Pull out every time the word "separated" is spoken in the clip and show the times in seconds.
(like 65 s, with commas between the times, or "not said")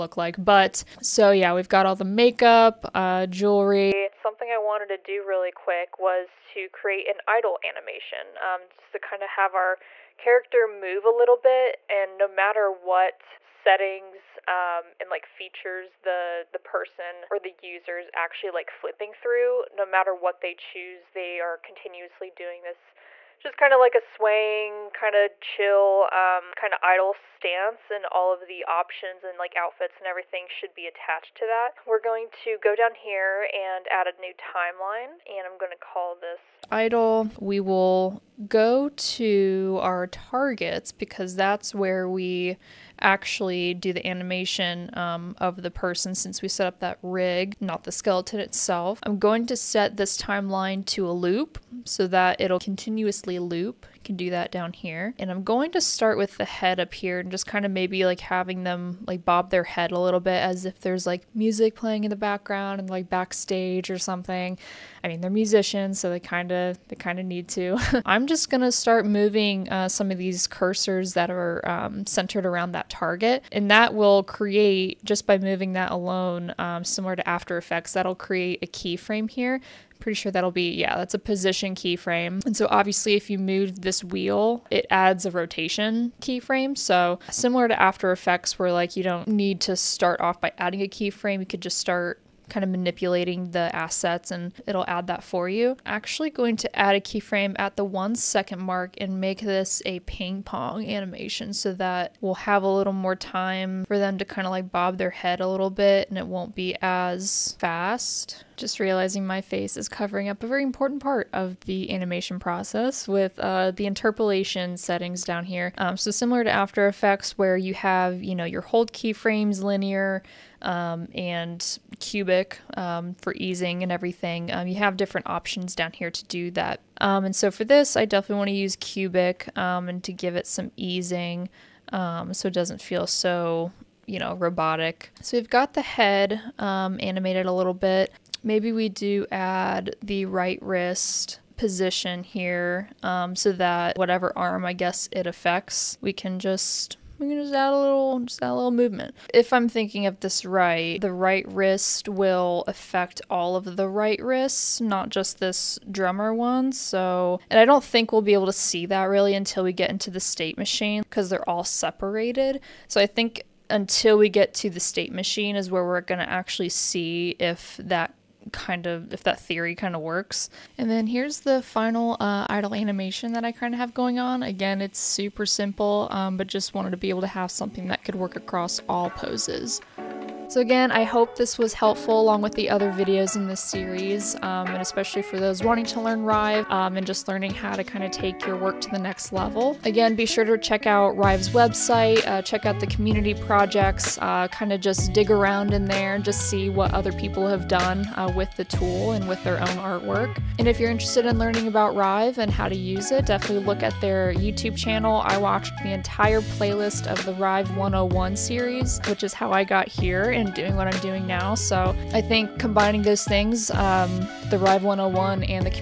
161 s.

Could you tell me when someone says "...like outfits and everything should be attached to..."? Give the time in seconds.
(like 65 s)
29 s.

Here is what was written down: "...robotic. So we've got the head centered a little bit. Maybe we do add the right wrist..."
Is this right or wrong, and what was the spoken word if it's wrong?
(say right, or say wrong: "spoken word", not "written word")
wrong: "animated", not "centered".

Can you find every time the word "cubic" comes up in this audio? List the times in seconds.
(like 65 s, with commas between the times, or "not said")
122 s, 128 s.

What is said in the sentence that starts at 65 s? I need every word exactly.
I mean, they're musicians, so they kind of they kind of need to.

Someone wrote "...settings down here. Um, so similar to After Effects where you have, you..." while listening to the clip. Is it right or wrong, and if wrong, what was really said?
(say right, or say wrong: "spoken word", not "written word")
right.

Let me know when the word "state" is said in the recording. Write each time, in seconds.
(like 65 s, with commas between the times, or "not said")
160 s, 164 s.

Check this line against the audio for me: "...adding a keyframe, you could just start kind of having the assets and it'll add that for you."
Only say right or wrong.
wrong.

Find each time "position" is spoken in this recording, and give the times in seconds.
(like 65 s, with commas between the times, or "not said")
81 s, 141 s.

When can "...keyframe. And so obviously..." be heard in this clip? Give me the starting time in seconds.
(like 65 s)
81 s.